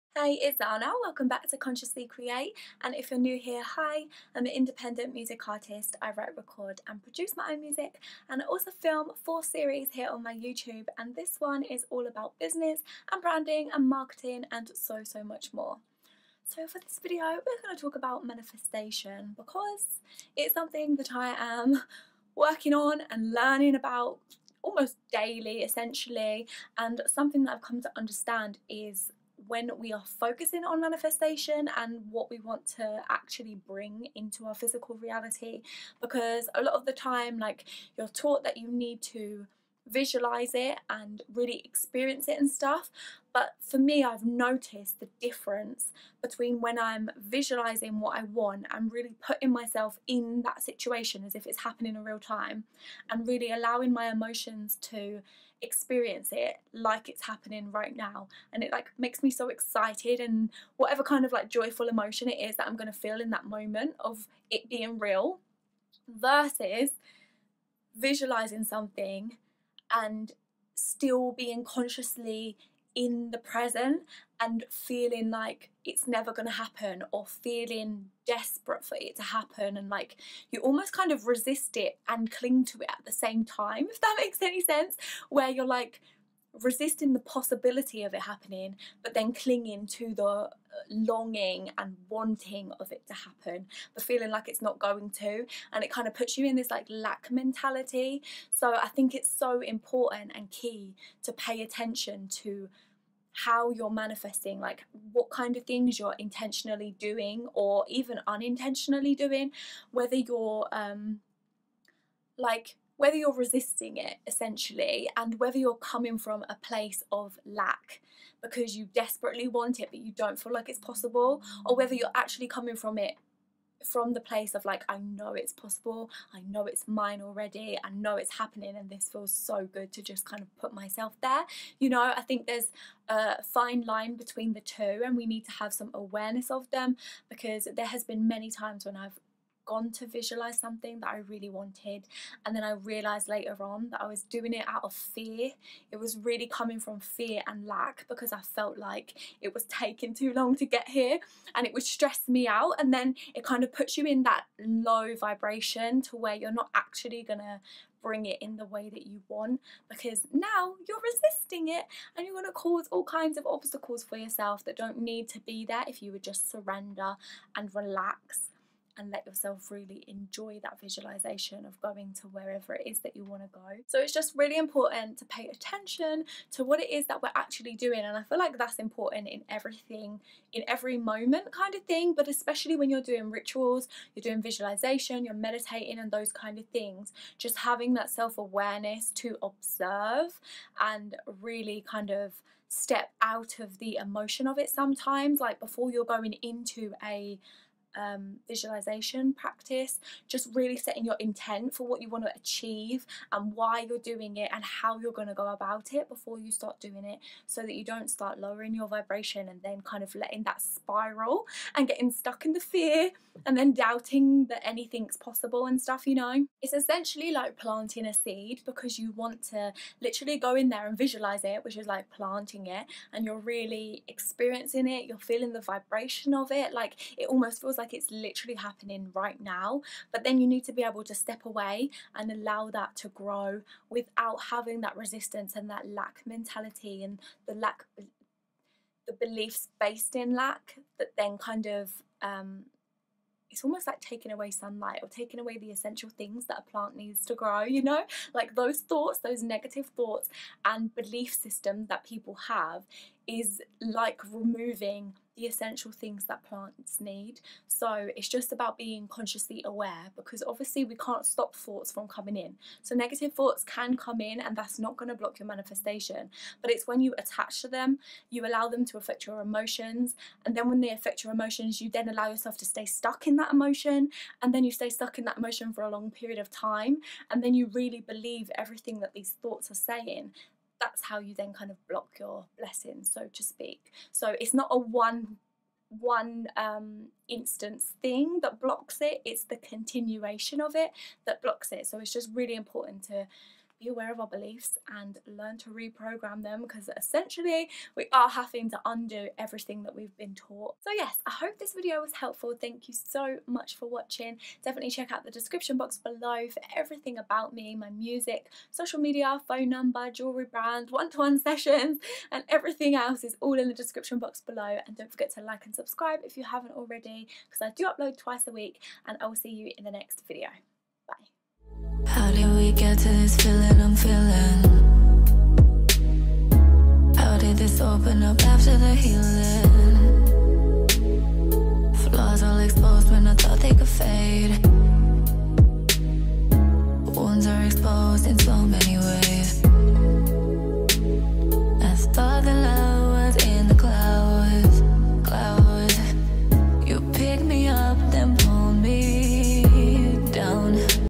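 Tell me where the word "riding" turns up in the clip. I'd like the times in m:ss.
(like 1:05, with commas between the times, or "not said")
not said.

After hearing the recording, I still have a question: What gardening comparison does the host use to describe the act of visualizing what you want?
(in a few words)
planting a seed.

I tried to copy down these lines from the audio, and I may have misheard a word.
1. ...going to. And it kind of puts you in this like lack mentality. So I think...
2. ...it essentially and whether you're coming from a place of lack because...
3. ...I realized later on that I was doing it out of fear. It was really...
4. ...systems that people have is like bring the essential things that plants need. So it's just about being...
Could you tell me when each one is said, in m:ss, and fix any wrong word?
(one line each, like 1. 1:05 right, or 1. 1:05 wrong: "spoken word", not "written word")
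1. 1:34 right
2. 1:53 right
3. 2:22 right
4. 4:11 wrong: "removing", not "bring".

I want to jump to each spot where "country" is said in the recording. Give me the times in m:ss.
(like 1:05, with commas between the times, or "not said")
not said.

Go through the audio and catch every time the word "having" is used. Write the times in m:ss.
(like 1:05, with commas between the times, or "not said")
3:07, 3:54, 4:58.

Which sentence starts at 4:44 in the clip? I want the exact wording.
So it's not a one one um, instance thing that blocks it, it's the continuation of it that blocks it.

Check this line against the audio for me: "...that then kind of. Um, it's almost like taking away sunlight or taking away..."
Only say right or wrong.
right.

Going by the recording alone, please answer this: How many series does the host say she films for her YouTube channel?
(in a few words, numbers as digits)
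4.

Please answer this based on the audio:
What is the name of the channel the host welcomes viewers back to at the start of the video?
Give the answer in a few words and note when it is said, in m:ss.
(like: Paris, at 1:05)
Consciously Create, at 0:01.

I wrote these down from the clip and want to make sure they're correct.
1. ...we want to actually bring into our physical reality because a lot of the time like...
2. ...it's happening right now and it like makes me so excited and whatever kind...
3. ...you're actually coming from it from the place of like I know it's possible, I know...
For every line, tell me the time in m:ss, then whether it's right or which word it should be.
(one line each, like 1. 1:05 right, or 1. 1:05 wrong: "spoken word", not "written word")
1. 0:32 right
2. 0:57 right
3. 2:01 right.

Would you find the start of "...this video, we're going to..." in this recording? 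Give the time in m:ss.
0:16.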